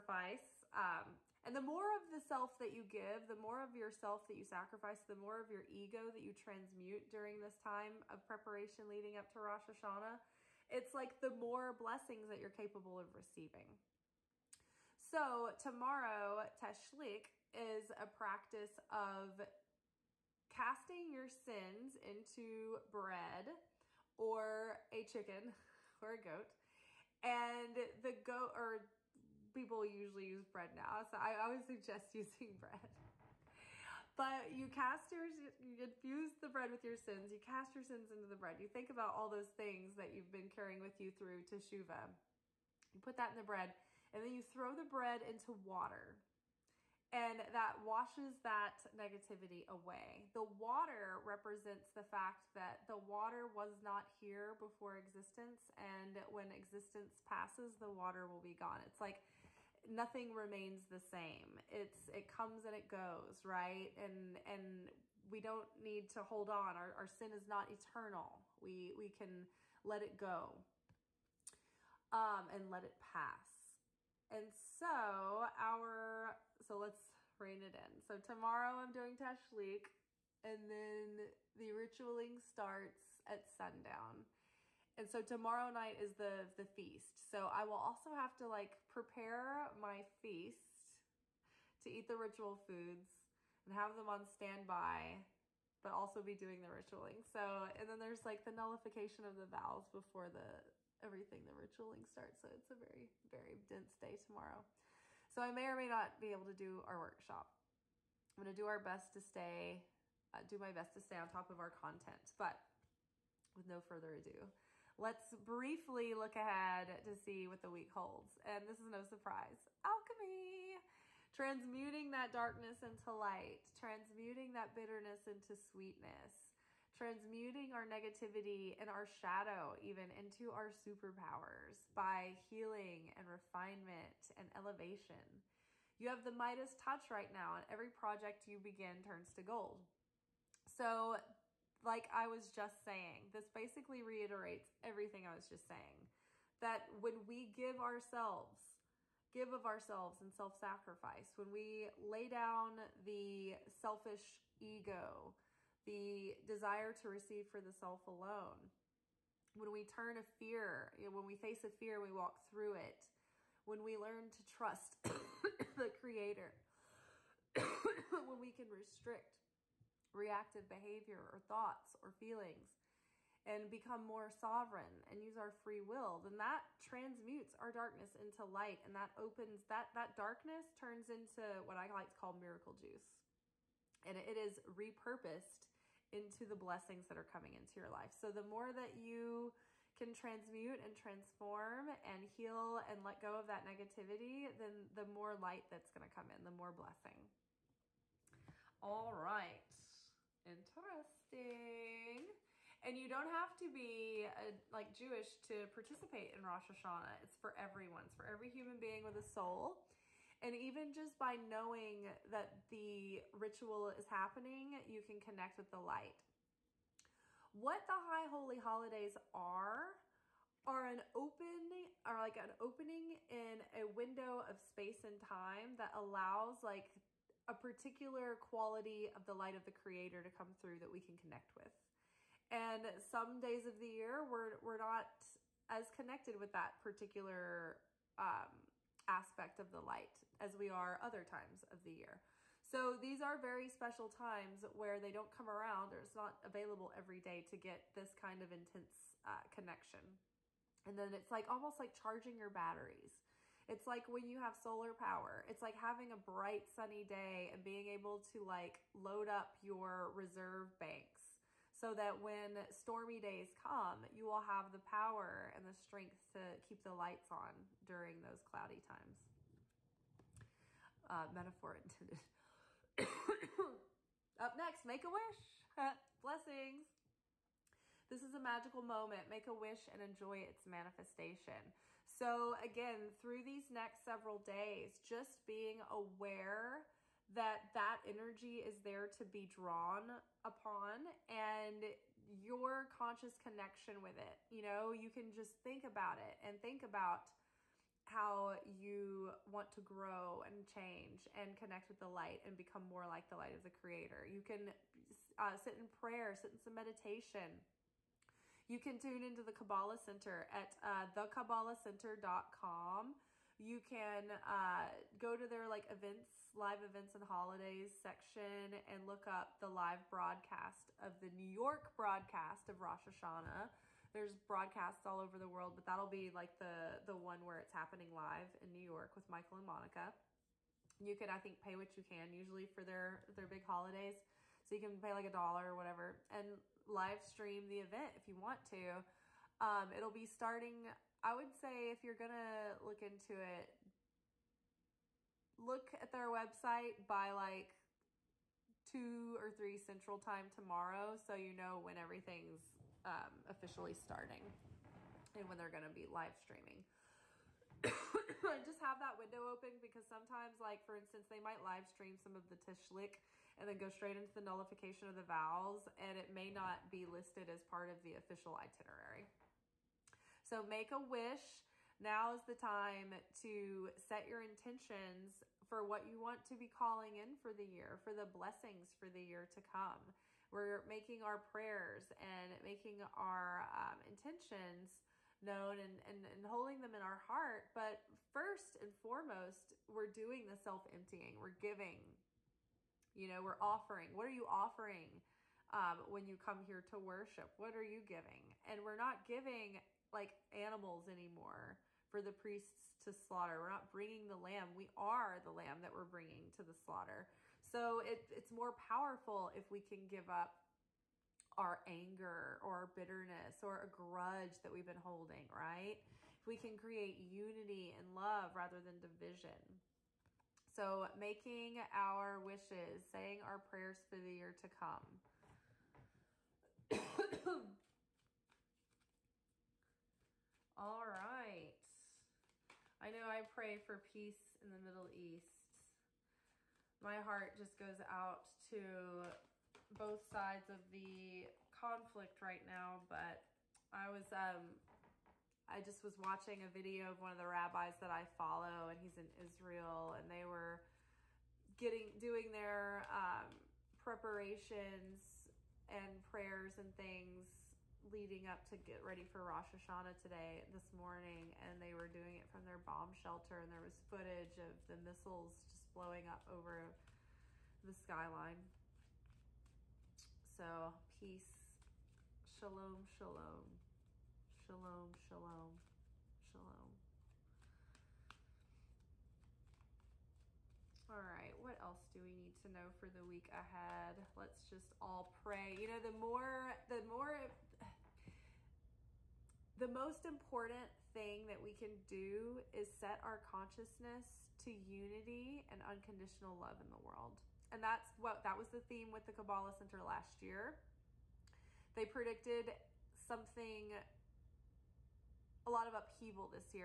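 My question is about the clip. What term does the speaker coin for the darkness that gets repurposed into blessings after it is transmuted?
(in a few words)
miracle juice.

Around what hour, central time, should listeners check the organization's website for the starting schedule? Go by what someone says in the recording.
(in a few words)
2 or 3.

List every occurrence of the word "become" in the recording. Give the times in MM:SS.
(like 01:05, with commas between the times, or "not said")
02:53, 05:02.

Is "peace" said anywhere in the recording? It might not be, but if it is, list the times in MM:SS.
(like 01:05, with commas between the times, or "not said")
07:13, 07:51.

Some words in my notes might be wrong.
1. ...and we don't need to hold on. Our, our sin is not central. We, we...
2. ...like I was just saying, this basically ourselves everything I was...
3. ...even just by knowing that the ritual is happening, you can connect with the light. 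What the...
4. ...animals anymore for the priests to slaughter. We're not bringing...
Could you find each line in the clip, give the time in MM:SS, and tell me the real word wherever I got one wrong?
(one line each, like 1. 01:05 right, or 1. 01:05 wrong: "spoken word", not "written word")
1. 01:04 wrong: "eternal", not "central"
2. 02:21 wrong: "reiterates", not "ourselves"
3. 03:30 right
4. 06:40 right.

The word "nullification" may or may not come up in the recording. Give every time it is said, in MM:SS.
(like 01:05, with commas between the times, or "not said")
01:38, 06:04.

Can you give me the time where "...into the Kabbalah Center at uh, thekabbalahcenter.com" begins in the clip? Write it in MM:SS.
05:09.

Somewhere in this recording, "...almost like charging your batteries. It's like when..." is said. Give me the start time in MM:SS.
04:11.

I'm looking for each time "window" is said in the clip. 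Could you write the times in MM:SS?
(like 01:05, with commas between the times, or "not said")
03:43, 05:59.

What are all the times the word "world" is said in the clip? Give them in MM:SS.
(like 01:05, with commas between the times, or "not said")
05:25, 08:16.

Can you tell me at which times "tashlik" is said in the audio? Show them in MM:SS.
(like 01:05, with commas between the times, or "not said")
00:16, 01:19, 06:02.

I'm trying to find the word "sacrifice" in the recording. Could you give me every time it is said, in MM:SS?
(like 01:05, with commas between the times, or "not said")
00:04, 02:30.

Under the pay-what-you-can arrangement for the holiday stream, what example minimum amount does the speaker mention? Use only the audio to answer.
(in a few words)
a dollar.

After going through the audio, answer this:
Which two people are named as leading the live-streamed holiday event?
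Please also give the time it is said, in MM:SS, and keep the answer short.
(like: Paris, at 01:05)
Michael and Monica, at 05:29.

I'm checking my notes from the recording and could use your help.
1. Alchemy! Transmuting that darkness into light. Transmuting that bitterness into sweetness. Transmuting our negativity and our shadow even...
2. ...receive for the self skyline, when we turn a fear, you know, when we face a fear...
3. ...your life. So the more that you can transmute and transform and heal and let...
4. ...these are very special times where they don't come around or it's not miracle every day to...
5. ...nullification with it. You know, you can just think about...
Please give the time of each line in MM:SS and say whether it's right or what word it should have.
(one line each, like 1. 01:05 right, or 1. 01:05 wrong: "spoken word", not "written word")
1. 01:59 right
2. 02:37 wrong: "alone", not "skyline"
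3. 03:07 right
4. 04:02 wrong: "available", not "miracle"
5. 04:53 wrong: "connection", not "nullification".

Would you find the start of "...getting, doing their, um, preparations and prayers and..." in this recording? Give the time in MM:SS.
07:31.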